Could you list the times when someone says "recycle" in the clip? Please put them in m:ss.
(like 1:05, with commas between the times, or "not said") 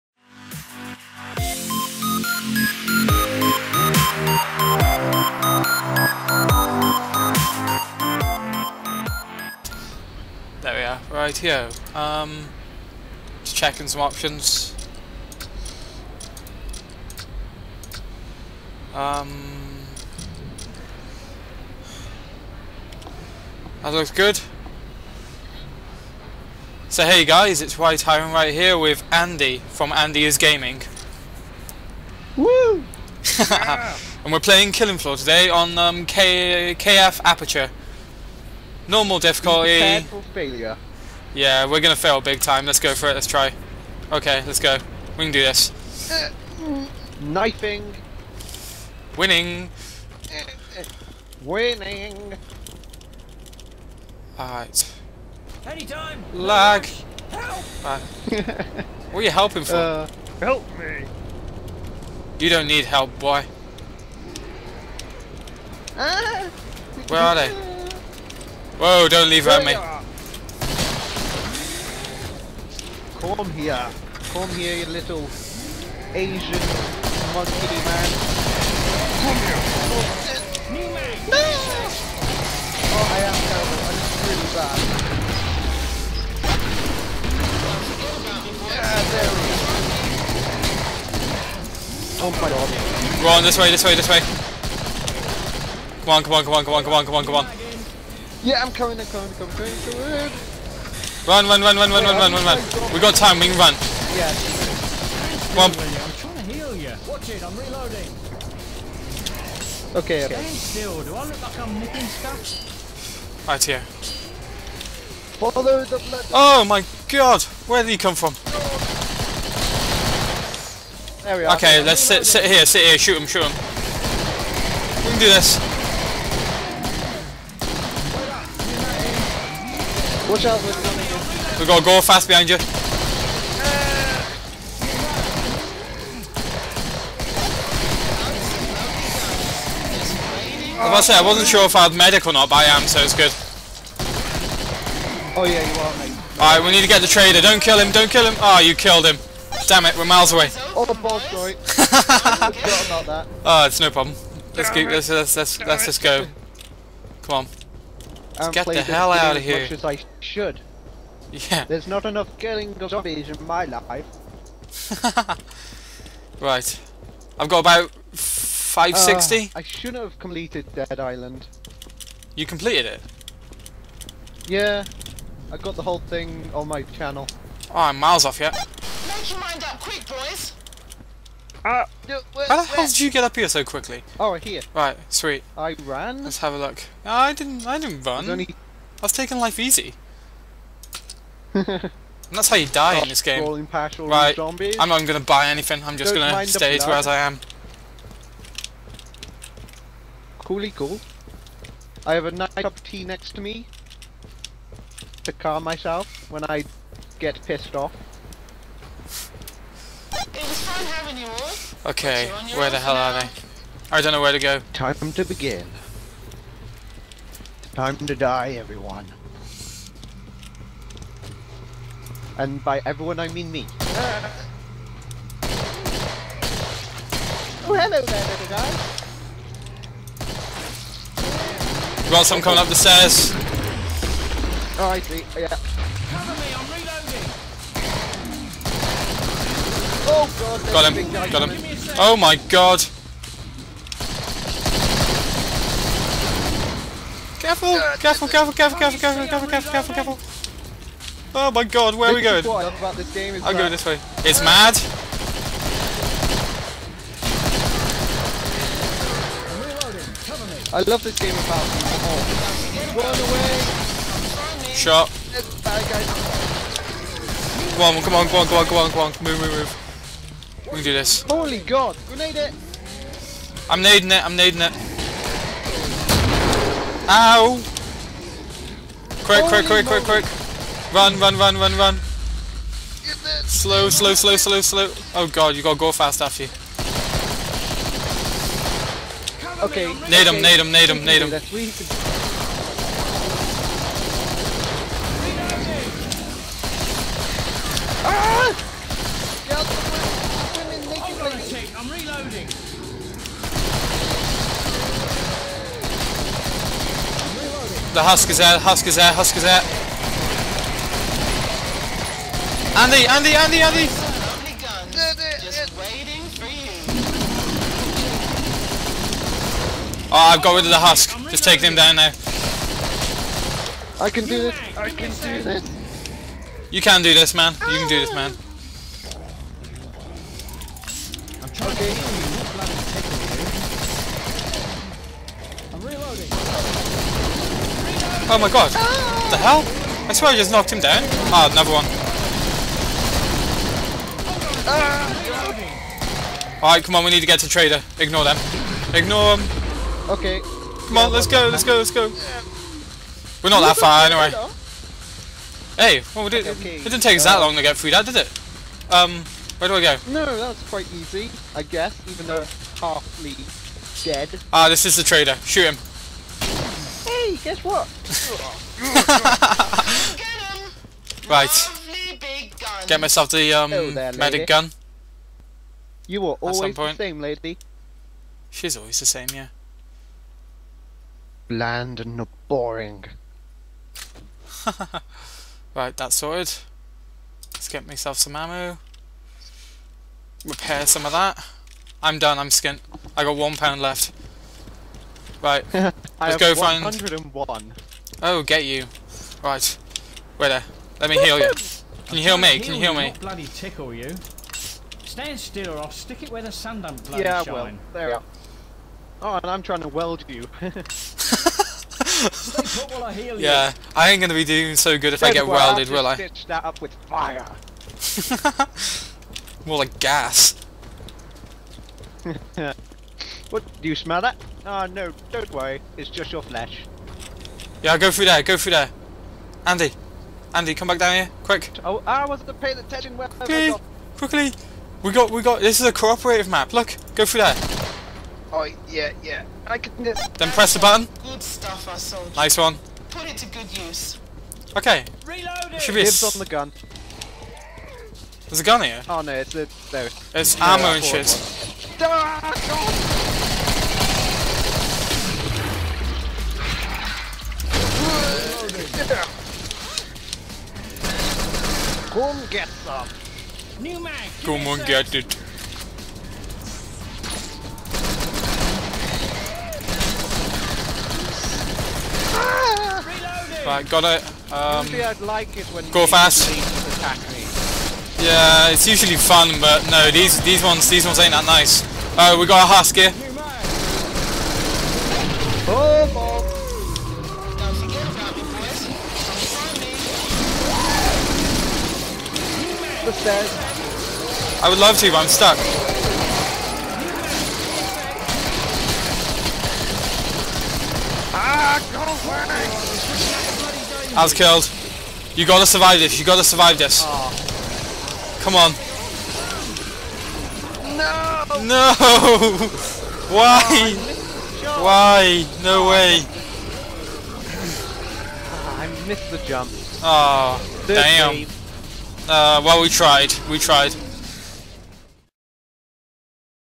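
not said.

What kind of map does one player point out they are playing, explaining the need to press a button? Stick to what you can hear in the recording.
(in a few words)
cooperative map.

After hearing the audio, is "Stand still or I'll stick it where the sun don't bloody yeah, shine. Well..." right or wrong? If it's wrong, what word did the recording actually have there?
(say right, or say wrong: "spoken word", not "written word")
right.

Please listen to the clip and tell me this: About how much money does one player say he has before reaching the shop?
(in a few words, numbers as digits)
560.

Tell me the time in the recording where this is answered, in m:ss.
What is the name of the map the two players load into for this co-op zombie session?
0:36.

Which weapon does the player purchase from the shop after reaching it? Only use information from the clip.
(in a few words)
medic gun.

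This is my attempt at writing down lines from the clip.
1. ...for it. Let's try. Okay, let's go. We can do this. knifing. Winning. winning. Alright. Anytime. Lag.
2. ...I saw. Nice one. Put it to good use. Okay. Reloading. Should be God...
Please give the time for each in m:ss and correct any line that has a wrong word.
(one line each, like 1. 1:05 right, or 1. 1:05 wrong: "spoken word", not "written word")
1. 0:42 right
2. 7:21 wrong: "Dibs", not "God".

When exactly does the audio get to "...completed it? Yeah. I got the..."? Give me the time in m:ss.
2:52.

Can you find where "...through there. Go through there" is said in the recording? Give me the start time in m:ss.
7:08.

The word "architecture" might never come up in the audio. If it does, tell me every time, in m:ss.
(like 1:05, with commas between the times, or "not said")
not said.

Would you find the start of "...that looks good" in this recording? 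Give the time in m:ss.
0:23.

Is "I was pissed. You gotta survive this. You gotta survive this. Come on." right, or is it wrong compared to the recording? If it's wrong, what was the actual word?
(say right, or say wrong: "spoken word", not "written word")
wrong: "killed", not "pissed".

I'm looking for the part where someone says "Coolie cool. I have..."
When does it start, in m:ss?
3:20.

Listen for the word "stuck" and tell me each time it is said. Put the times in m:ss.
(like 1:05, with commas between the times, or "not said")
8:15.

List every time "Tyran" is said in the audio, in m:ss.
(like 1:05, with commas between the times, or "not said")
0:27.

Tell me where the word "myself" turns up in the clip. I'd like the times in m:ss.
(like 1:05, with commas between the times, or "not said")
3:25, 6:13, 6:27.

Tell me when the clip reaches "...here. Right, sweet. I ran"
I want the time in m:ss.
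3:04.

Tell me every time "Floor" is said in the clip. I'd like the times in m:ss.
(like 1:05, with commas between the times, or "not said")
0:34.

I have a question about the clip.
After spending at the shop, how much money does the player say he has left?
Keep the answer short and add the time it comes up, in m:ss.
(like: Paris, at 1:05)
one pound, at 6:33.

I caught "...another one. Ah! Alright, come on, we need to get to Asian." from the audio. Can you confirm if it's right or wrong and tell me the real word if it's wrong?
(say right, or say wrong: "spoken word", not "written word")
wrong: "Trader", not "Asian".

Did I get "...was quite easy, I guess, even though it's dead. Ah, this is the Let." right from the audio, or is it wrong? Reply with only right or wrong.
wrong.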